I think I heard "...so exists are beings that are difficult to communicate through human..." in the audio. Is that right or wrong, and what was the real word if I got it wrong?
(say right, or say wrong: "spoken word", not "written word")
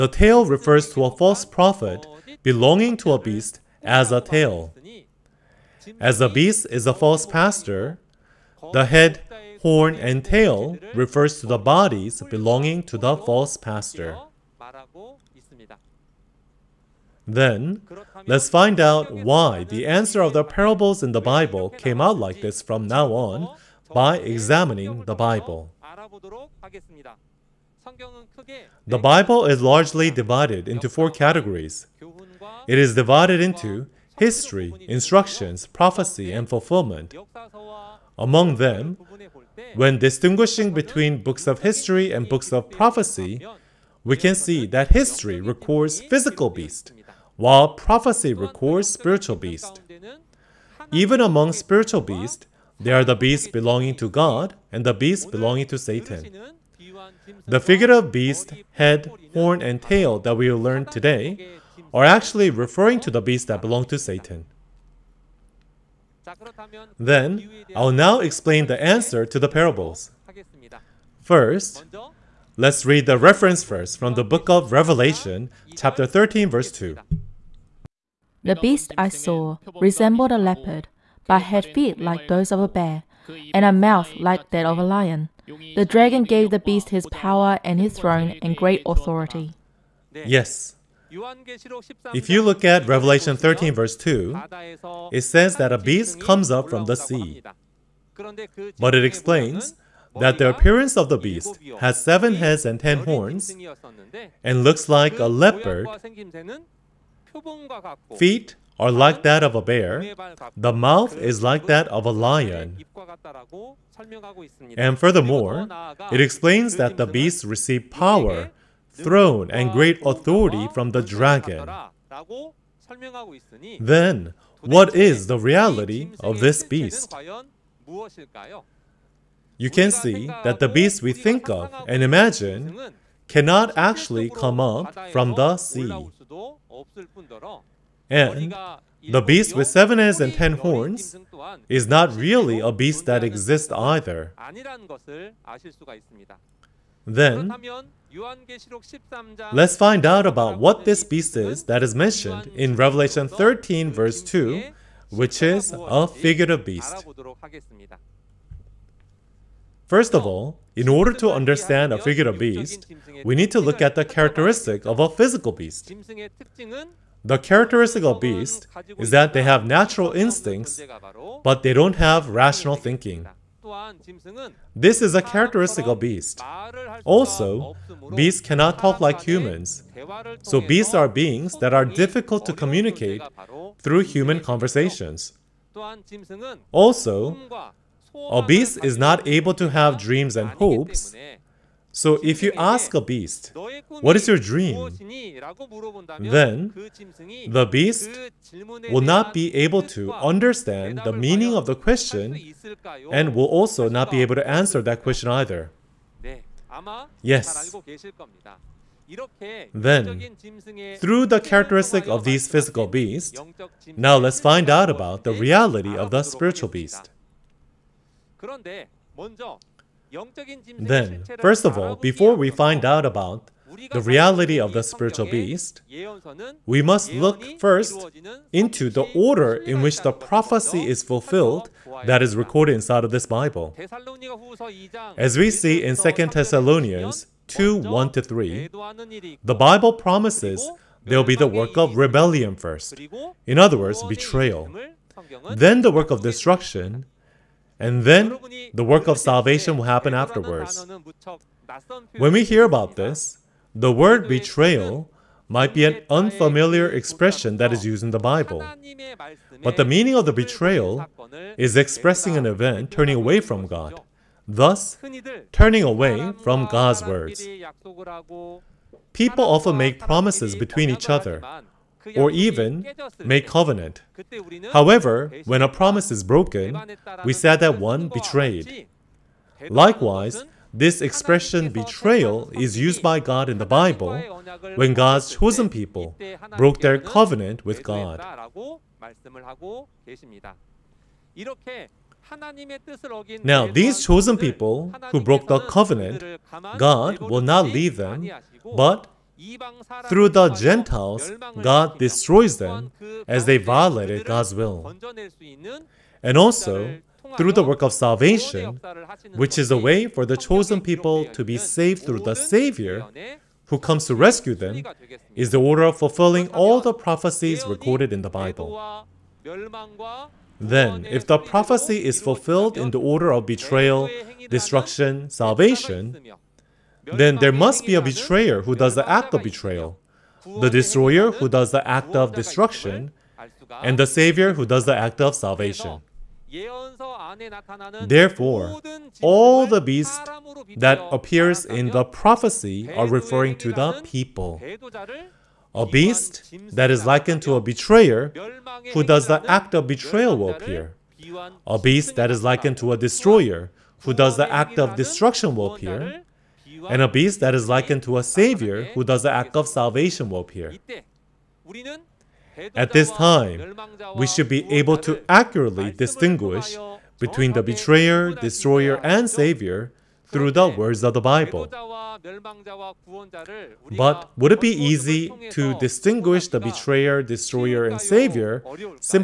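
wrong: "beasts", not "exists".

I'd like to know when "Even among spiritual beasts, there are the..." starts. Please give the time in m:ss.
0:50.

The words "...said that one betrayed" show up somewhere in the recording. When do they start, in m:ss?
4:37.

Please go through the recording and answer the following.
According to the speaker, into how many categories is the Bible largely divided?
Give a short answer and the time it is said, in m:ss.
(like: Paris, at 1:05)
4, at 0:30.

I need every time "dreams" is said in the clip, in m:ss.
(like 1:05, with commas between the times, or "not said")
3:09, 3:14.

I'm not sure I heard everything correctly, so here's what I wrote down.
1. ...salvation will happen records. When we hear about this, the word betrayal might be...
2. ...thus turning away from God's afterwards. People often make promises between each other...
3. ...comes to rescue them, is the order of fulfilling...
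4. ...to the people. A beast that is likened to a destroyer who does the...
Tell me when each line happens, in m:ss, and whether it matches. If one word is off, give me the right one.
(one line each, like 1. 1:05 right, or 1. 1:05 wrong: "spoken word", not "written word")
1. 4:09 wrong: "afterwards", not "records"
2. 4:24 wrong: "words", not "afterwards"
3. 5:13 right
4. 5:43 wrong: "betrayer", not "destroyer".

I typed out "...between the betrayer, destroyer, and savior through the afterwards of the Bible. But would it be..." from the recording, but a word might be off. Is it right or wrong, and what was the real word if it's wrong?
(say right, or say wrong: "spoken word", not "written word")
wrong: "words", not "afterwards".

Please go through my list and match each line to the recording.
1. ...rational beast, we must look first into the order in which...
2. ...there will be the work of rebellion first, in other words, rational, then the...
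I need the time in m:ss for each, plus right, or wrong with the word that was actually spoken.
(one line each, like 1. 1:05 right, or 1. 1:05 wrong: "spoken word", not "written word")
1. 3:44 wrong: "spiritual", not "rational"
2. 4:01 wrong: "betrayal", not "rational".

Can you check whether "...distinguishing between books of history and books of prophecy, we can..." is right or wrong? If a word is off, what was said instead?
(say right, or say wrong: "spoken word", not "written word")
right.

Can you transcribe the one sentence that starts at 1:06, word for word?
Then, I'll now explain the answer to the parables.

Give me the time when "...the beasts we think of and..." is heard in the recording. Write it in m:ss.
2:10.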